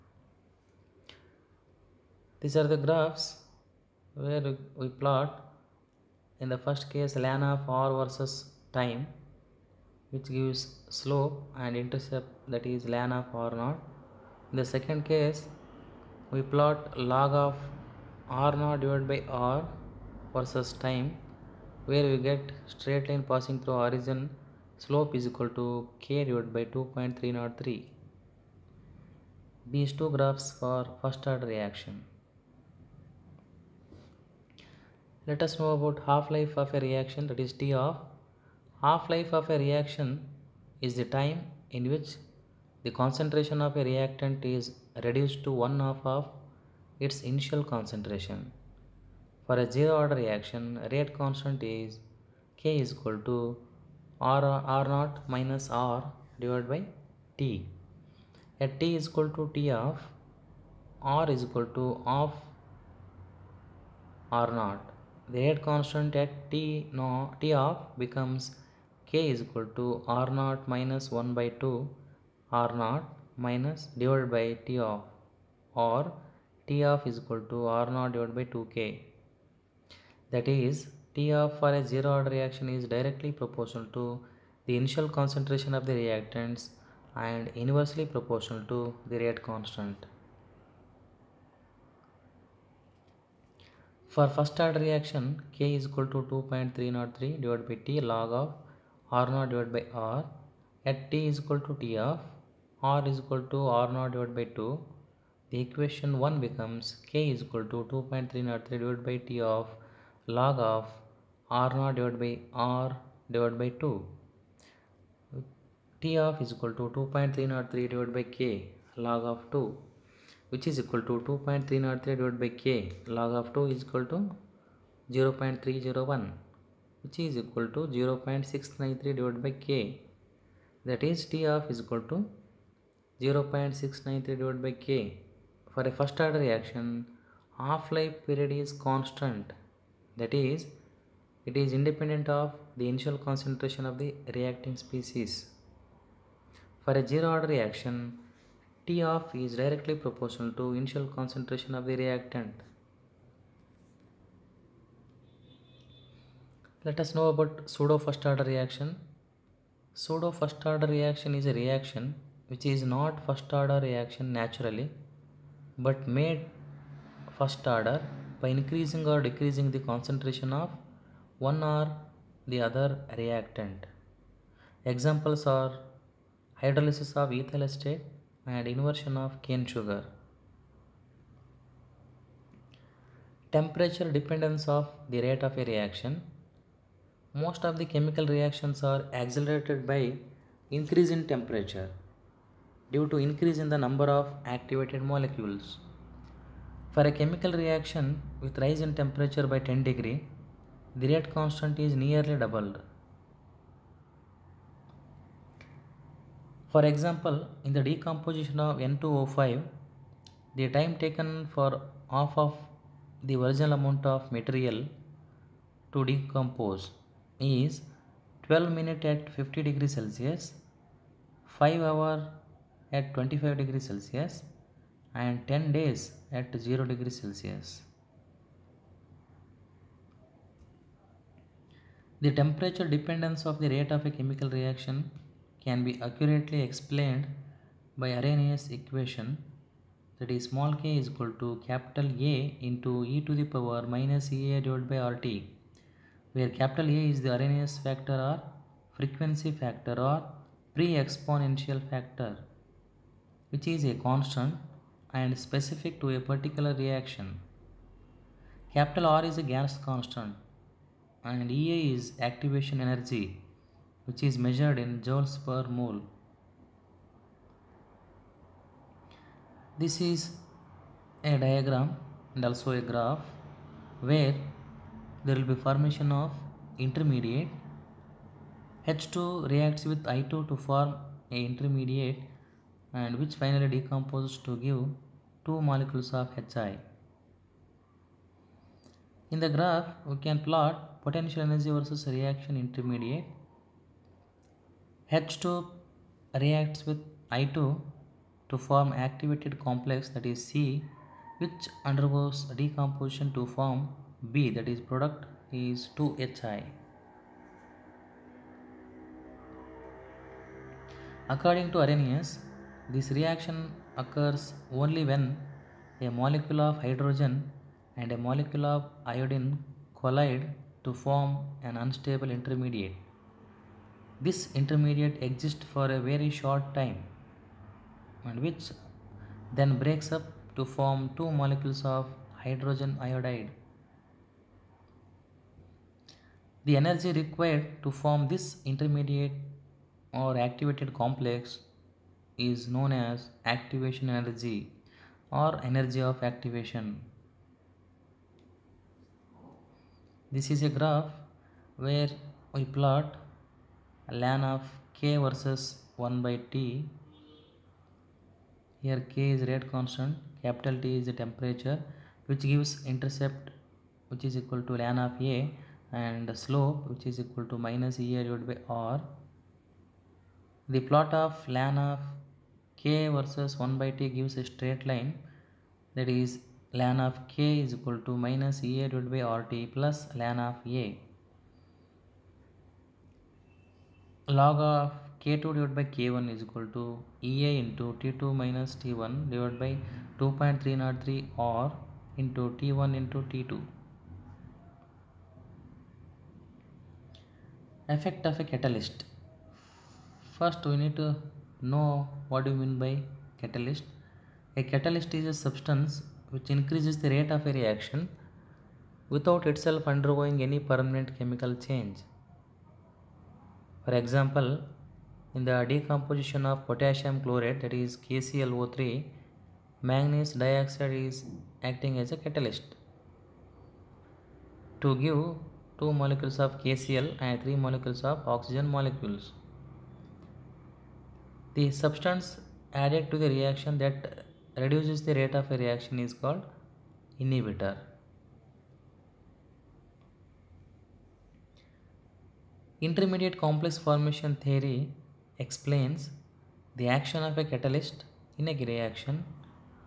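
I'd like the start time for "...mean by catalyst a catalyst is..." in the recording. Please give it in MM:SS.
06:42.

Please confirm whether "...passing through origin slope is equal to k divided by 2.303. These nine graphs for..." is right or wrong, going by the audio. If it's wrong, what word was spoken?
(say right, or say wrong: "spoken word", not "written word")
wrong: "two", not "nine".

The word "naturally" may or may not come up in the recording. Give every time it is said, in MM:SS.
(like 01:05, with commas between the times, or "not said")
02:44.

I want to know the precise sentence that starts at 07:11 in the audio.
The substance added to the reaction that reduces the rate of a reaction is called inhibitor.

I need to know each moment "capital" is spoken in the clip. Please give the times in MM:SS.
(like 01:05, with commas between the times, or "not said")
04:01, 04:06, 04:18, 06:00.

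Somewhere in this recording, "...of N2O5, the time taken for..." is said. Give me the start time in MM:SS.
03:28.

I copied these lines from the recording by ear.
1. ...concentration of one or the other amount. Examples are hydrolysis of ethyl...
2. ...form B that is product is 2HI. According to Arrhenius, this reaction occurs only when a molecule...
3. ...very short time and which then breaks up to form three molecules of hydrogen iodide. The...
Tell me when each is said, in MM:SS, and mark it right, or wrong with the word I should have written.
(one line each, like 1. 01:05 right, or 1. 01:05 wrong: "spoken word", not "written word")
1. 02:49 wrong: "reactant", not "amount"
2. 05:03 right
3. 05:25 wrong: "two", not "three".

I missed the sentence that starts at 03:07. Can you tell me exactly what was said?
Most of the chemical reactions are accelerated by increase in temperature due to increase in the number of activated molecules.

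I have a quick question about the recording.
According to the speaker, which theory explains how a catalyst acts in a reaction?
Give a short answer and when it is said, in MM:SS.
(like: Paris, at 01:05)
Intermediate complex formation theory, at 07:22.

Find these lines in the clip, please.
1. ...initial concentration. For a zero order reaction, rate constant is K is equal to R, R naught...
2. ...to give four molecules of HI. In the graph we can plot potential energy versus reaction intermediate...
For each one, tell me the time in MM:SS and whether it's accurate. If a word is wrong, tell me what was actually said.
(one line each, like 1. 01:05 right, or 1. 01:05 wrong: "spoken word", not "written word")
1. 00:47 right
2. 04:44 wrong: "two", not "four".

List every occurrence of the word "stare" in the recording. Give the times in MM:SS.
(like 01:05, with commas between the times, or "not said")
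not said.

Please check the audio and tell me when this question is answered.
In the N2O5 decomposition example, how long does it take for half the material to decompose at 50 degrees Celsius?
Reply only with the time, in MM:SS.
03:38.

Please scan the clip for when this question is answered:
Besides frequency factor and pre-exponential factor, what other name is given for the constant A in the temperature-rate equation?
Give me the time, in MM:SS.
04:07.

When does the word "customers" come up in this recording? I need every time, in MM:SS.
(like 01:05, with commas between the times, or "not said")
not said.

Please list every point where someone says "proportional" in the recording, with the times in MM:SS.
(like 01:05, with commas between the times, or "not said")
01:23, 01:28, 02:30.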